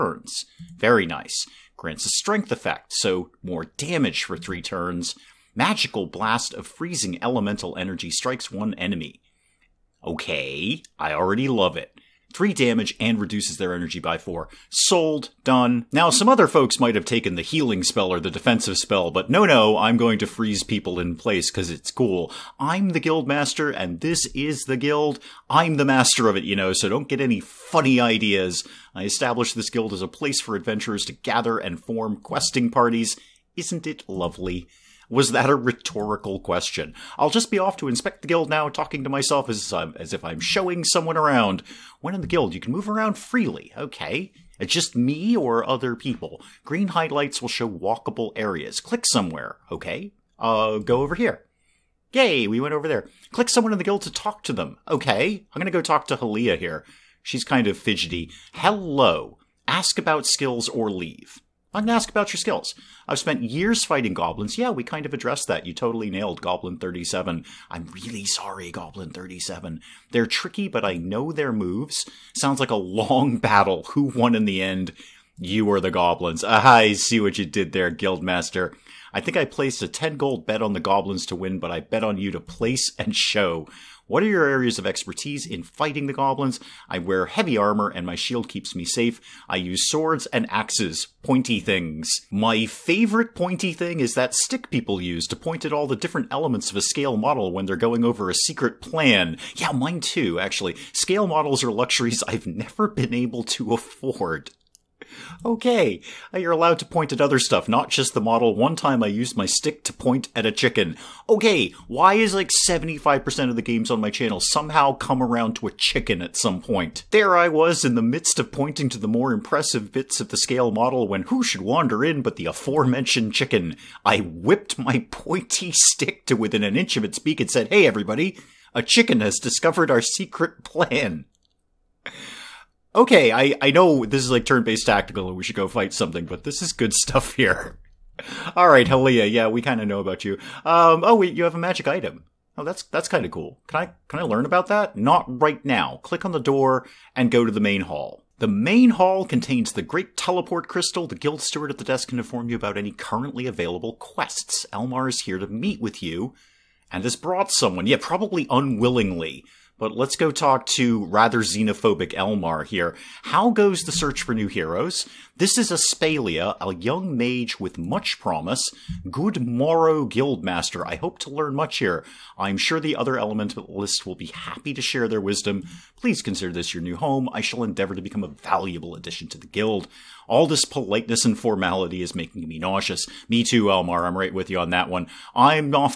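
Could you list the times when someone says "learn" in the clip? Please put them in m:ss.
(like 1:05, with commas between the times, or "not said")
2:24, 2:51.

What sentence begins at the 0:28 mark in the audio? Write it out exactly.
I established this guild as a place for adventurers to gather and form questing parties.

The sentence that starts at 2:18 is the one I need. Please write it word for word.
All right, Halia, yeah, we kind of know about you.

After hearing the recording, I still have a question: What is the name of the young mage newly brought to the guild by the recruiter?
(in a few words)
Aspalia.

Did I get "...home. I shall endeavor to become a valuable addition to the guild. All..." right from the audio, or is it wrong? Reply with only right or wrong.
right.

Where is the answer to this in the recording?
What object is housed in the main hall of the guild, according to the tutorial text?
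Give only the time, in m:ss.
2:29.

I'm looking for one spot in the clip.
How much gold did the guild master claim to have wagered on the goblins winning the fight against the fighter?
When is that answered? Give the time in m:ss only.
1:19.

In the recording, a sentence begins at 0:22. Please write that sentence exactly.
I'm the guild master, and this is the guild.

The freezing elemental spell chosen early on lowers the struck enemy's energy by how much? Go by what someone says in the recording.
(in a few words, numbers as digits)
4.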